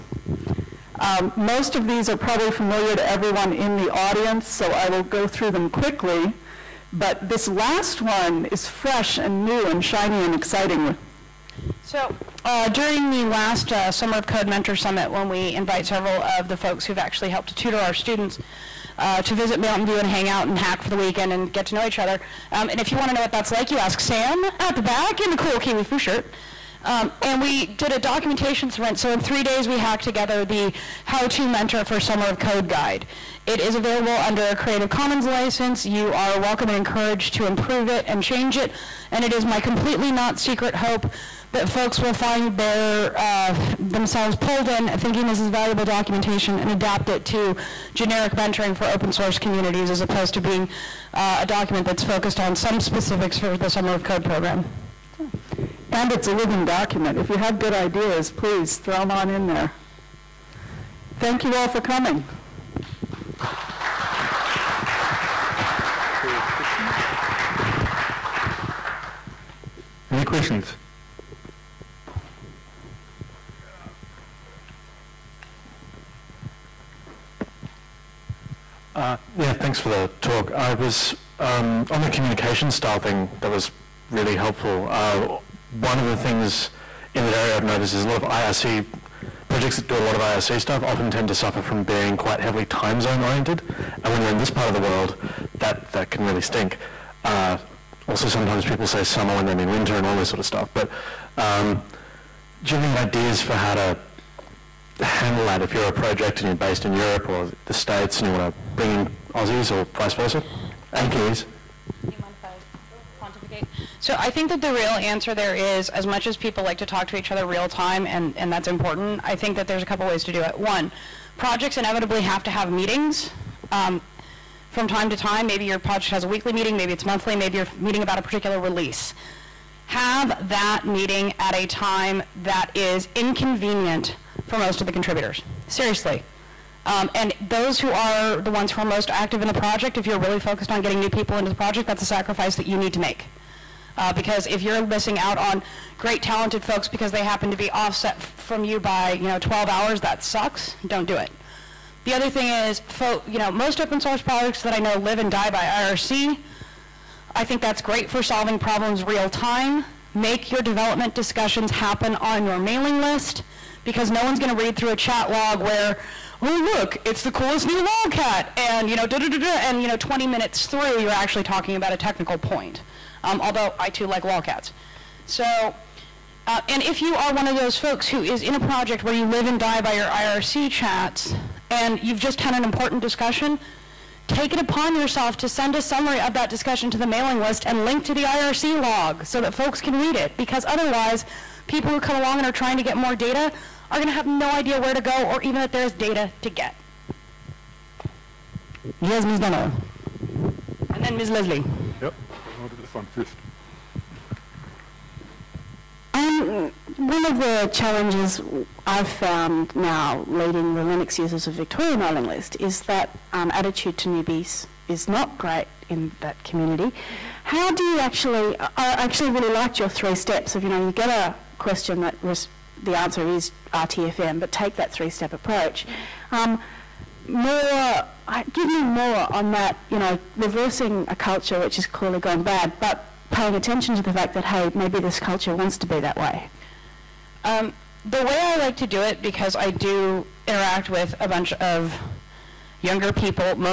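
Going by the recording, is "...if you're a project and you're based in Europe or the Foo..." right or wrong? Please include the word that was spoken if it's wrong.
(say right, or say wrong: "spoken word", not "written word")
wrong: "States", not "Foo".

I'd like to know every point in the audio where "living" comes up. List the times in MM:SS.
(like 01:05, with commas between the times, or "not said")
00:56.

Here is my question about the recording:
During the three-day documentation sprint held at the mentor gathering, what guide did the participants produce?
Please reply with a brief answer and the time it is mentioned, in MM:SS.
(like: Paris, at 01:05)
How to Mentor for Summer of Code, at 00:31.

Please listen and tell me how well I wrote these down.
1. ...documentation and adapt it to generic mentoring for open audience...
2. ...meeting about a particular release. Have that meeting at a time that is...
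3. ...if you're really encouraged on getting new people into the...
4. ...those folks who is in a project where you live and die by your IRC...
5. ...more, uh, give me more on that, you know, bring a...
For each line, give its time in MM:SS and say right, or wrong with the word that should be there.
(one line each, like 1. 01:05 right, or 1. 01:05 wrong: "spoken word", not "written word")
1. 00:45 wrong: "source", not "audience"
2. 02:07 right
3. 02:19 wrong: "focused", not "encouraged"
4. 02:57 right
5. 03:47 wrong: "reversing", not "bring".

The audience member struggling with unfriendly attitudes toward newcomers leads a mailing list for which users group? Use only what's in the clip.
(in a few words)
Linux users of Victoria.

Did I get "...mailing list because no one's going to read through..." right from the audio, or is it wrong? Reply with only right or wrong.
right.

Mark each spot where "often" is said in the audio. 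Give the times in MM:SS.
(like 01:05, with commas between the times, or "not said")
01:30.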